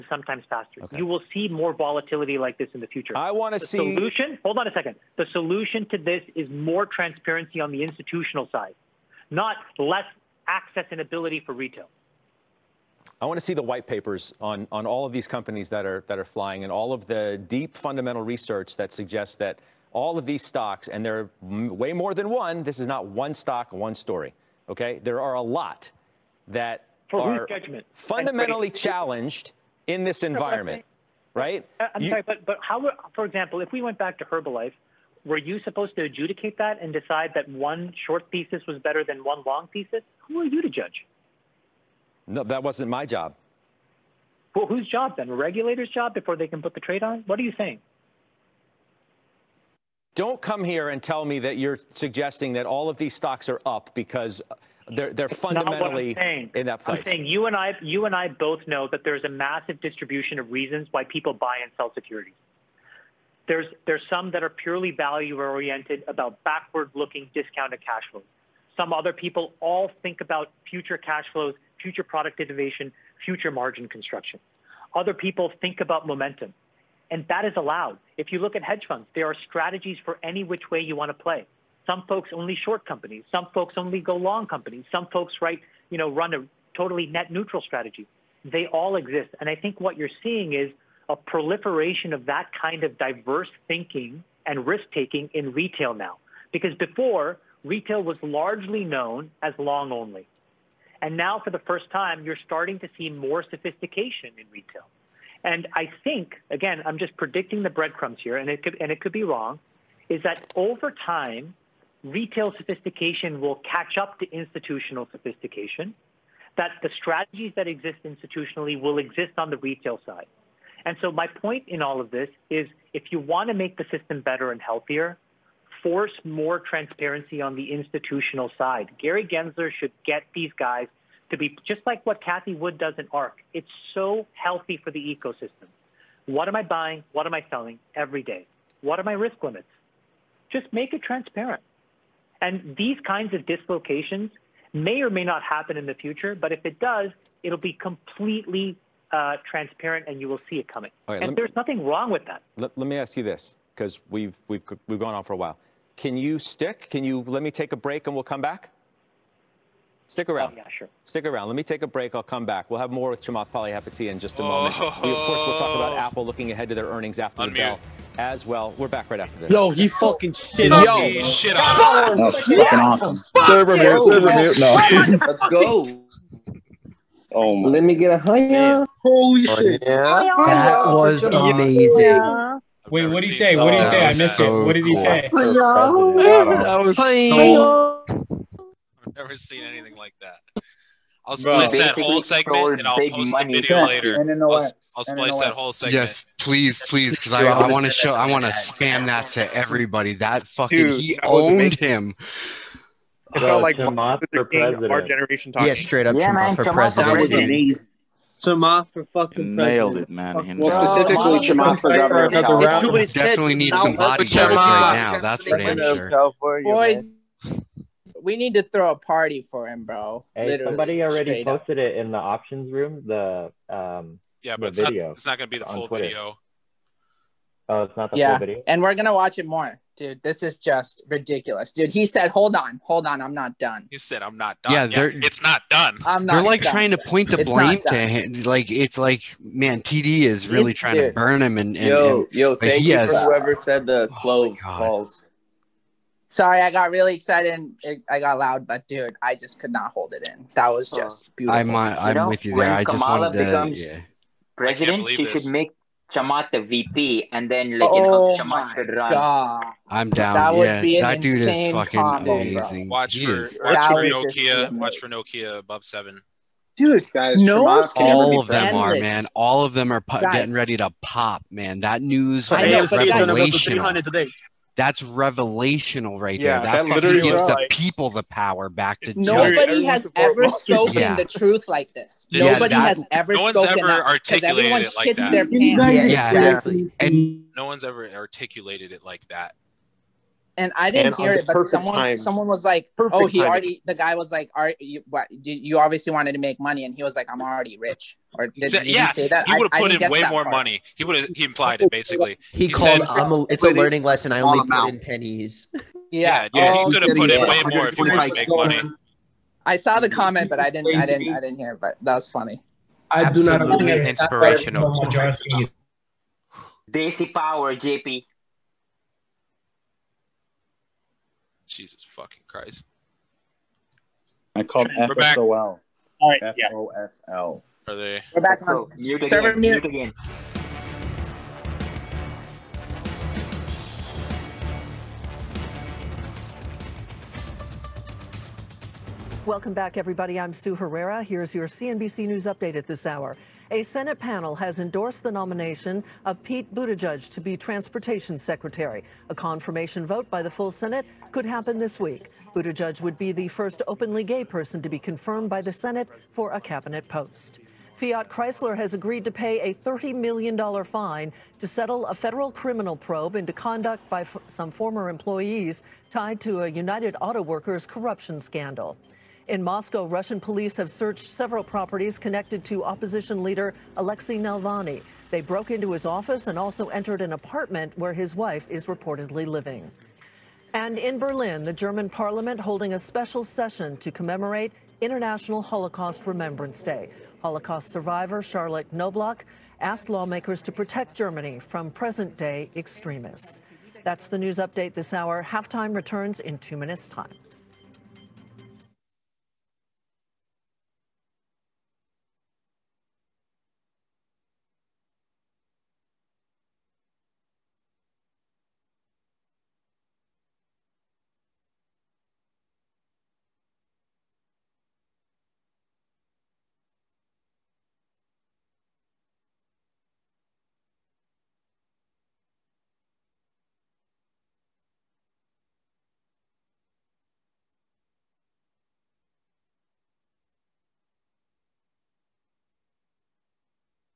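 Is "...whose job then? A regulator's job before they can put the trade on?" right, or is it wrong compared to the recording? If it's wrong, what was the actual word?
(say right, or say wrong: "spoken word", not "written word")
right.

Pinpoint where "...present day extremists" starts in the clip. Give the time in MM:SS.
06:31.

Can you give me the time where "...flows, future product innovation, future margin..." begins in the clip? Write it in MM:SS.
01:11.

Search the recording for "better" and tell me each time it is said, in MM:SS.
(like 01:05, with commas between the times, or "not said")
00:38, 02:04.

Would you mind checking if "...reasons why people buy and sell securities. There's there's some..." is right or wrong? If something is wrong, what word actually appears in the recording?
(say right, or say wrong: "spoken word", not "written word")
right.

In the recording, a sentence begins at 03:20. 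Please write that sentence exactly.
That fucking Dude, he that owned him.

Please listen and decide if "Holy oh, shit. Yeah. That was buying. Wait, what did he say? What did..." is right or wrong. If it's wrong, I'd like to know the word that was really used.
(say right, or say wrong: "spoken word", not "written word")
wrong: "amazing", not "buying".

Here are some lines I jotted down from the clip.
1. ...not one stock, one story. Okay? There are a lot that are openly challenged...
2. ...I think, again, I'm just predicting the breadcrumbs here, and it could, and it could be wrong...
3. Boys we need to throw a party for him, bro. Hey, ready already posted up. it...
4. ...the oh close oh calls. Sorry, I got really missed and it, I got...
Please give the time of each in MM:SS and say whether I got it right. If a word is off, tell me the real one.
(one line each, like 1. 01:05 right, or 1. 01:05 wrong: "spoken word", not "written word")
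1. 00:22 wrong: "fundamentally", not "openly"
2. 01:45 right
3. 03:36 wrong: "somebody", not "ready"
4. 04:03 wrong: "excited", not "missed".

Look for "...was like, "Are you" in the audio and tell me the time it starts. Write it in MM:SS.
04:54.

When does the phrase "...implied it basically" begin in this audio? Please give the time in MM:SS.
05:01.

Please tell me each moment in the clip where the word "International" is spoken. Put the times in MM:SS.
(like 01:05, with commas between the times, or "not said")
06:25.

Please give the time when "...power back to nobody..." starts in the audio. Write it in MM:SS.
04:38.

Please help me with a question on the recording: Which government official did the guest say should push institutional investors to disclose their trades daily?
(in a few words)
Gary Gensler.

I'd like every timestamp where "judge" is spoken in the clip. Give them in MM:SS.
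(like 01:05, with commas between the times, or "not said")
00:40, 04:39.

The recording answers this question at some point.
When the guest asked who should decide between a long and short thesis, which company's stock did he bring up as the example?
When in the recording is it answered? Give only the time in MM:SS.
00:34.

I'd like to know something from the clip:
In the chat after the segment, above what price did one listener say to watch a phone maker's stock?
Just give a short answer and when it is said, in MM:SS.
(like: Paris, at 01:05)
7, at 04:25.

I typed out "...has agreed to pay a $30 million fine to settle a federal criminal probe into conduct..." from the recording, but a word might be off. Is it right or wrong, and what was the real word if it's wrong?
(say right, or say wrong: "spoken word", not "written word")
right.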